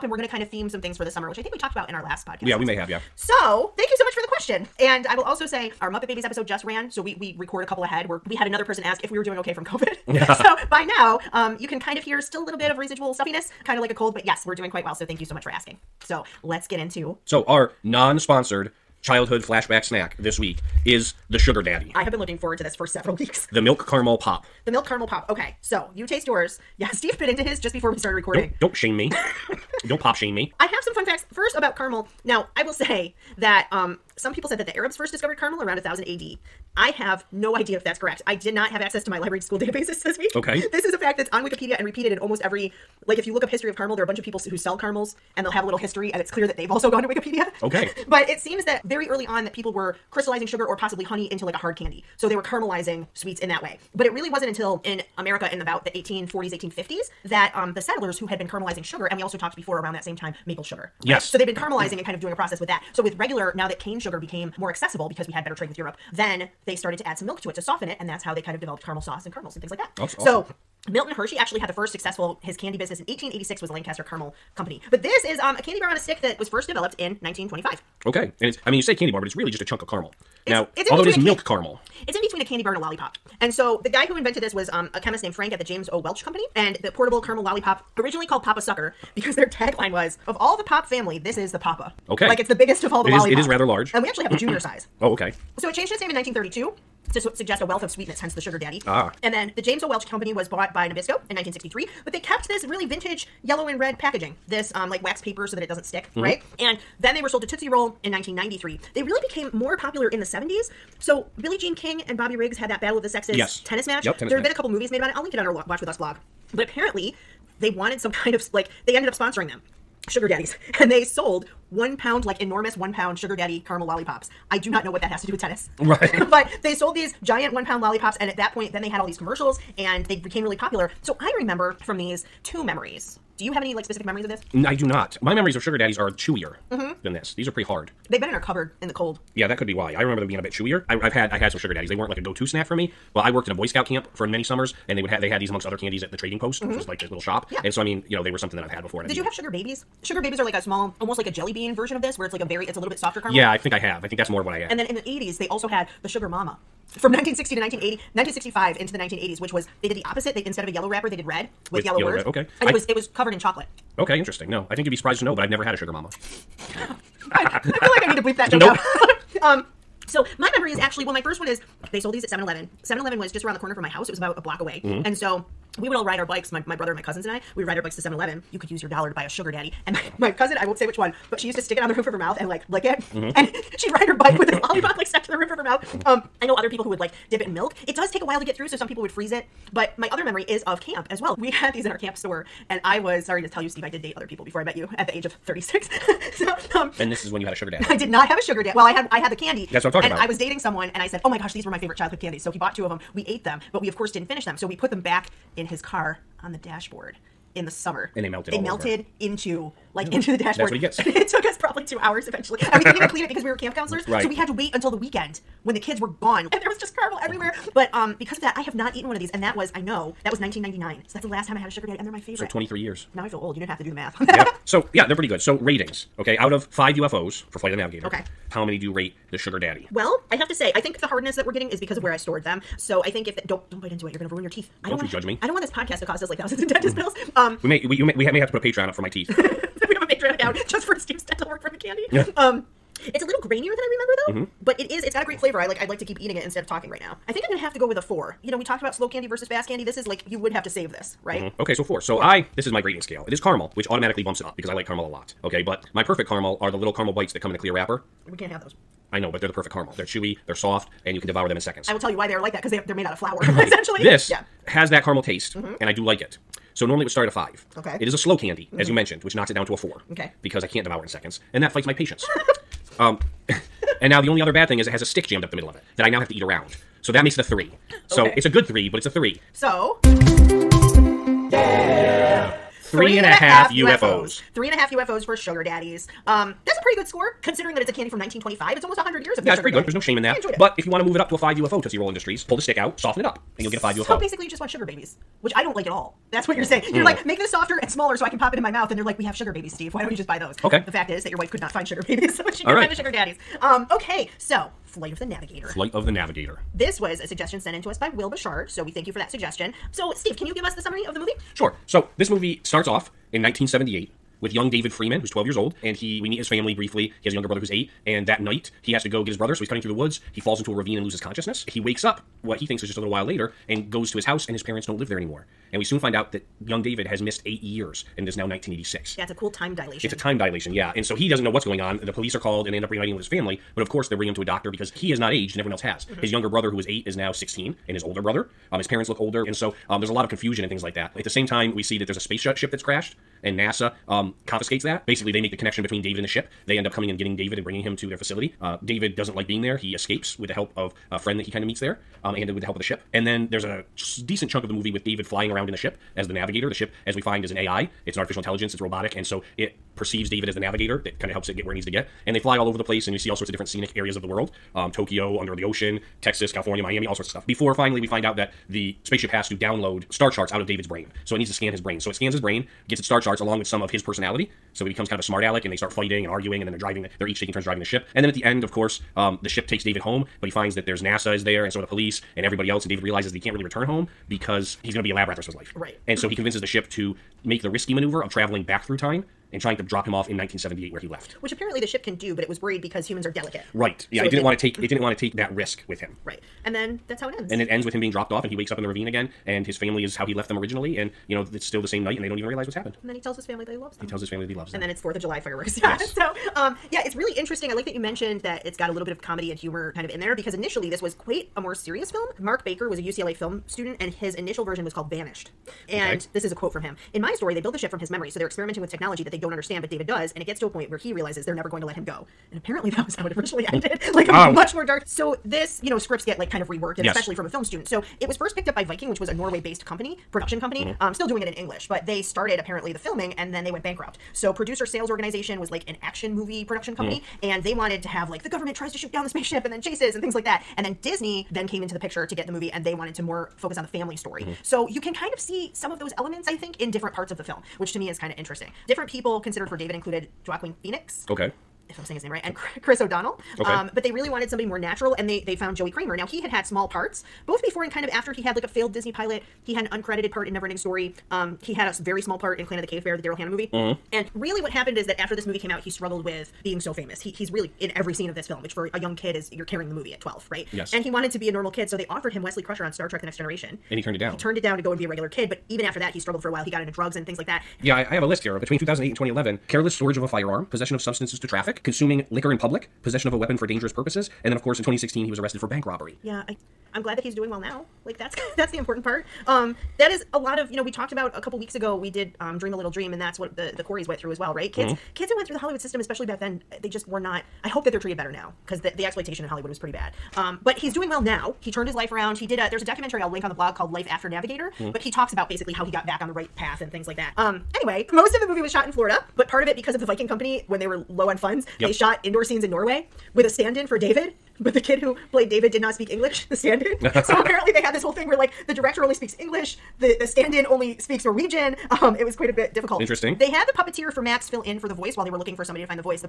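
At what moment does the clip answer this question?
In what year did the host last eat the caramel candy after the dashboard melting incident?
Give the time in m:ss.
3:40.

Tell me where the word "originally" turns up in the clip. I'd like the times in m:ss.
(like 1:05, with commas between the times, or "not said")
1:27, 6:40, 7:03.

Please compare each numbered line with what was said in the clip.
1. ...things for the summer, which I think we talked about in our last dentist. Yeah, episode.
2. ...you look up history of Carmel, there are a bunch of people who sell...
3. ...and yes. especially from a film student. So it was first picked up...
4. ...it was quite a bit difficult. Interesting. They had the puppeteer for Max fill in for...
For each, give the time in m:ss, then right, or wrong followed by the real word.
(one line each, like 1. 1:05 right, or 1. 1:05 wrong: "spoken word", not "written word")
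1. 0:00 wrong: "podcast", not "dentist"
2. 0:43 right
3. 7:06 right
4. 8:42 right.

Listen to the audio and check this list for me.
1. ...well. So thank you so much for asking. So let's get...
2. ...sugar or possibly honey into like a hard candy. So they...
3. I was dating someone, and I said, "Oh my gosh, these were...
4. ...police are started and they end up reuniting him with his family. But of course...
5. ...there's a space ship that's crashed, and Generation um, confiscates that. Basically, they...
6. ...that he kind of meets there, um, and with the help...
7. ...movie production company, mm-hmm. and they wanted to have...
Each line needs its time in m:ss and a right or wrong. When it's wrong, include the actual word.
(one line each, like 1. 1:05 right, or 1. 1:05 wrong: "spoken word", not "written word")
1. 0:14 right
2. 0:50 right
3. 3:20 right
4. 5:32 wrong: "called", not "started"
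5. 5:42 wrong: "NASA", not "Generation"
6. 5:51 right
7. 7:16 right.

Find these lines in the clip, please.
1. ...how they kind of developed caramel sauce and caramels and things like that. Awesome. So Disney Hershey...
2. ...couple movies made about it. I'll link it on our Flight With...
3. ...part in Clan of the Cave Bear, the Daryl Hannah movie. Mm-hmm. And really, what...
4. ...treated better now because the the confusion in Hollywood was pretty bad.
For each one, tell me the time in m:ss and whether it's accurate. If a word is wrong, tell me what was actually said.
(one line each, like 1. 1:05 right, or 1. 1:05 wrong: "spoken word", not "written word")
1. 1:08 wrong: "Milton", not "Disney"
2. 1:54 wrong: "Watch", not "Flight"
3. 7:42 right
4. 8:17 wrong: "exploitation", not "confusion".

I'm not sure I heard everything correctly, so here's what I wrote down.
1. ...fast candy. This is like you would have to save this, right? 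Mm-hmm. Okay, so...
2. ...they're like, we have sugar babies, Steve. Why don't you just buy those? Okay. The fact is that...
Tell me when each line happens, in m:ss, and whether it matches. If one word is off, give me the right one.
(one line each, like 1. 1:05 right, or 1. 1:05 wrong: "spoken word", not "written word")
1. 4:09 right
2. 4:58 right.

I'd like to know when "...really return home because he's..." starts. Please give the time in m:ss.
6:23.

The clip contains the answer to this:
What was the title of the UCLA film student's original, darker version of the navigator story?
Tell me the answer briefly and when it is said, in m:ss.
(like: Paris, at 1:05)
Vanished, at 6:55.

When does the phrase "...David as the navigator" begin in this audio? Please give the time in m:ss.
6:00.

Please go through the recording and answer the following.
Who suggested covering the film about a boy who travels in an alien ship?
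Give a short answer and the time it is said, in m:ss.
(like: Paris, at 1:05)
Will Bouchard, at 5:08.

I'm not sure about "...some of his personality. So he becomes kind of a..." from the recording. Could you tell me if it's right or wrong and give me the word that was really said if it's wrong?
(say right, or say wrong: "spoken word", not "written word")
right.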